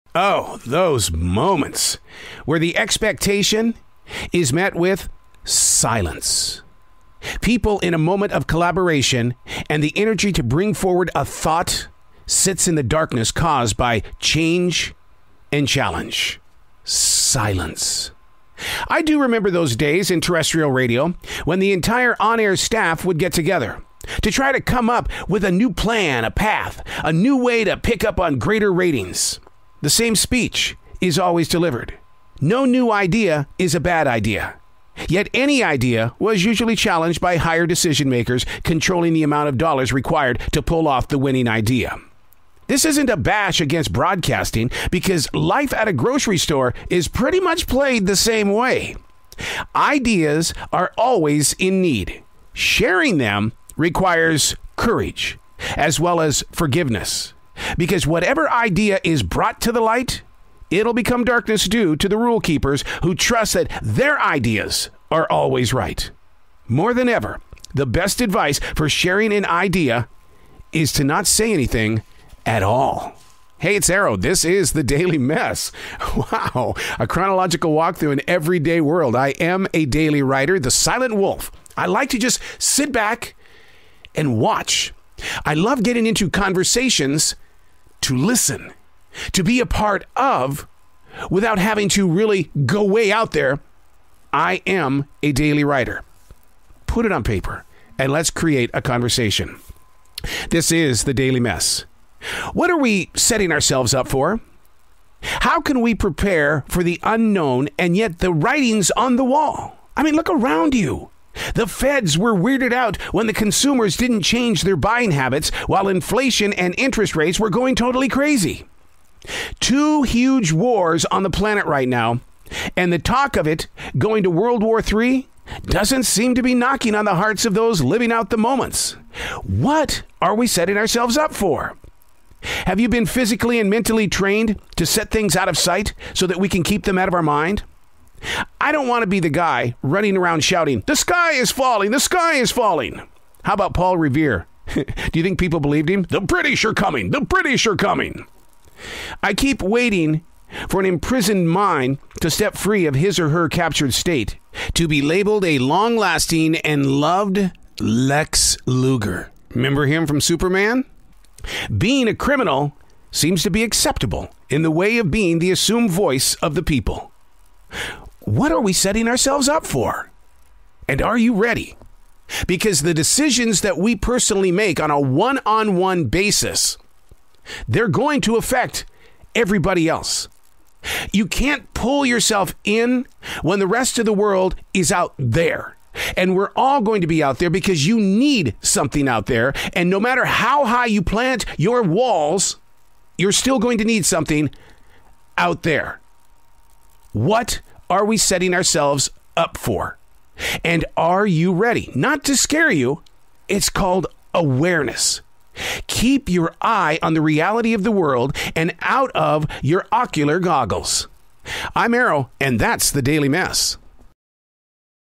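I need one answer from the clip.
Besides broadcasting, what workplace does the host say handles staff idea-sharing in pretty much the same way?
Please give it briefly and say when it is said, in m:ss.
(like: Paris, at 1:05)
grocery store, at 0:45.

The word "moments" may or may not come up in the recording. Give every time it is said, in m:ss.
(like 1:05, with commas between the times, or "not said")
0:01, 0:07, 2:08.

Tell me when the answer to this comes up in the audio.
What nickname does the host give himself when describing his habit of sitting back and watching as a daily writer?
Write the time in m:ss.
1:20.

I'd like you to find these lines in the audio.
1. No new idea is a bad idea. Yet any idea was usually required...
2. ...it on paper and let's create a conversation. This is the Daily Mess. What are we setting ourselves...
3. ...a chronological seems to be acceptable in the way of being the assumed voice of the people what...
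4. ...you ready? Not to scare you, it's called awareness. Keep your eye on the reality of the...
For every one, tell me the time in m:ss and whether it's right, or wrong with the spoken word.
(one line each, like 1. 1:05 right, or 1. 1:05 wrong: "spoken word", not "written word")
1. 0:32 wrong: "challenged", not "required"
2. 1:37 right
3. 2:42 wrong: "criminal", not "chronological"
4. 3:21 right.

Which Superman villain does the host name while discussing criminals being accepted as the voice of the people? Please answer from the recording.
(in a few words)
Lex Luger.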